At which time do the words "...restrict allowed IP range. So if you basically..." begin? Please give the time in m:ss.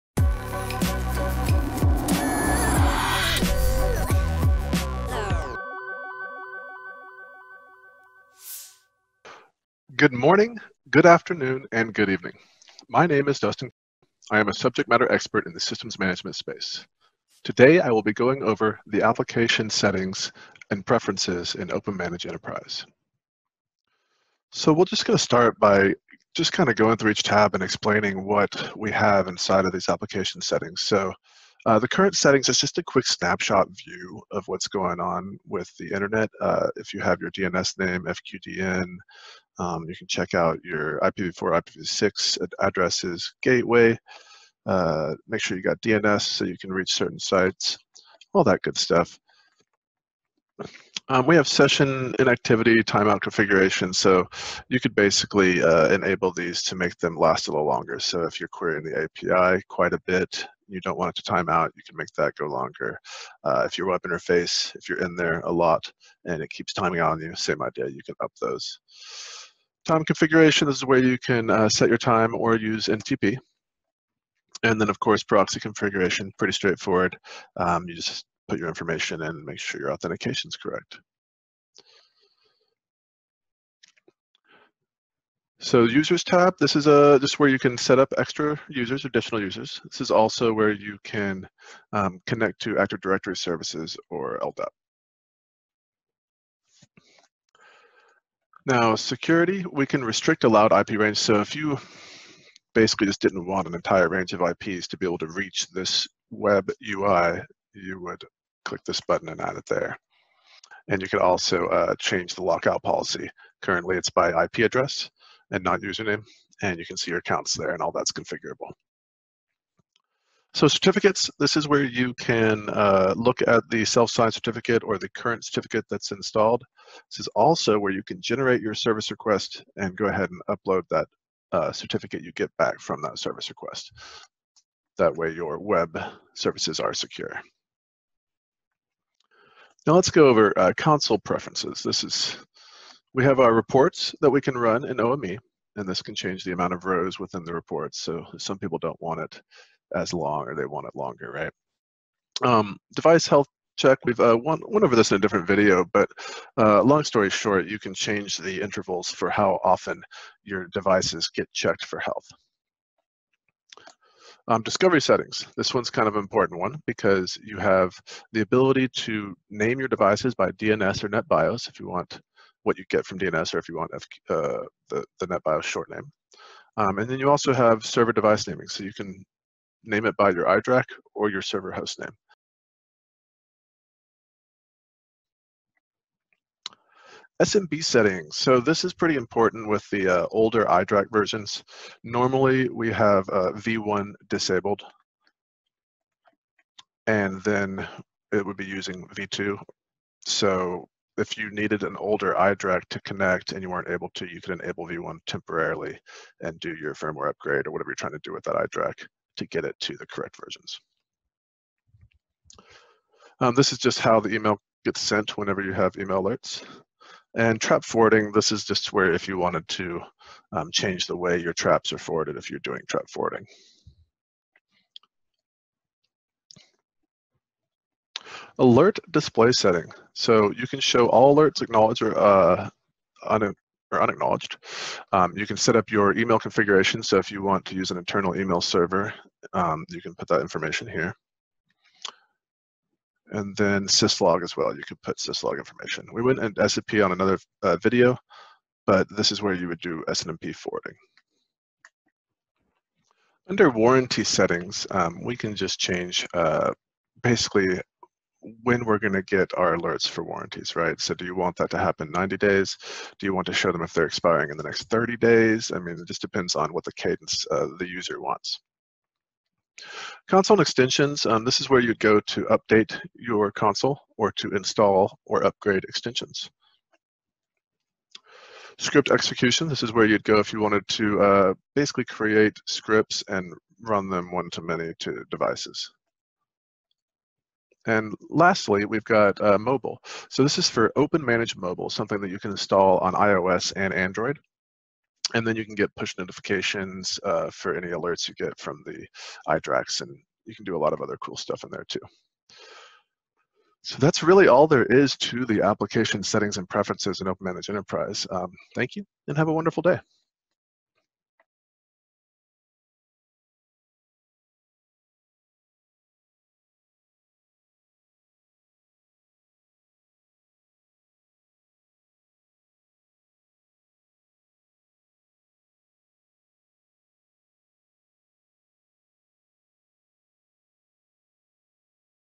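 1:40.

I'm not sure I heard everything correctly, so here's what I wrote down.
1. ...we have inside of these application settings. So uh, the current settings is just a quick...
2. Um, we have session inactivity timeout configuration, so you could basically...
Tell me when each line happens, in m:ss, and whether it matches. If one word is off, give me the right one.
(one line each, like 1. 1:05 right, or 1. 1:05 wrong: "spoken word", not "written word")
1. 0:28 right
2. 0:51 right.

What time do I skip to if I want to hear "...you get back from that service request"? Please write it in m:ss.
2:12.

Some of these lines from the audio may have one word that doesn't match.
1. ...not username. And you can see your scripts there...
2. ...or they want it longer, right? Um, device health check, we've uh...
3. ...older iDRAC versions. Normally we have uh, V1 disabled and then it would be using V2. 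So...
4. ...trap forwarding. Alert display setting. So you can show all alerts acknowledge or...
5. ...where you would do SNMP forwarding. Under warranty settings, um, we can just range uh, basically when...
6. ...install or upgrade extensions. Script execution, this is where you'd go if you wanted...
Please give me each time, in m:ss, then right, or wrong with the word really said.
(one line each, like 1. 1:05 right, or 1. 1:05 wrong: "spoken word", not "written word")
1. 1:55 wrong: "accounts", not "scripts"
2. 2:30 right
3. 3:10 right
4. 3:42 right
5. 4:09 wrong: "change", not "range"
6. 4:34 right.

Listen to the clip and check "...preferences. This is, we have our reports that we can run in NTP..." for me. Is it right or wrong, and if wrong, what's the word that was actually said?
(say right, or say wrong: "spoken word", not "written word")
wrong: "OME", not "NTP".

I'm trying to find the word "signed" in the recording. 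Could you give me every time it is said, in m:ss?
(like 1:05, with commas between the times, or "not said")
2:03.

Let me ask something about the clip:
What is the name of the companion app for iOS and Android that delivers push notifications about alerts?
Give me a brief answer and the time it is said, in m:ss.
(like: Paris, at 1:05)
Open Mobile, at 4:50.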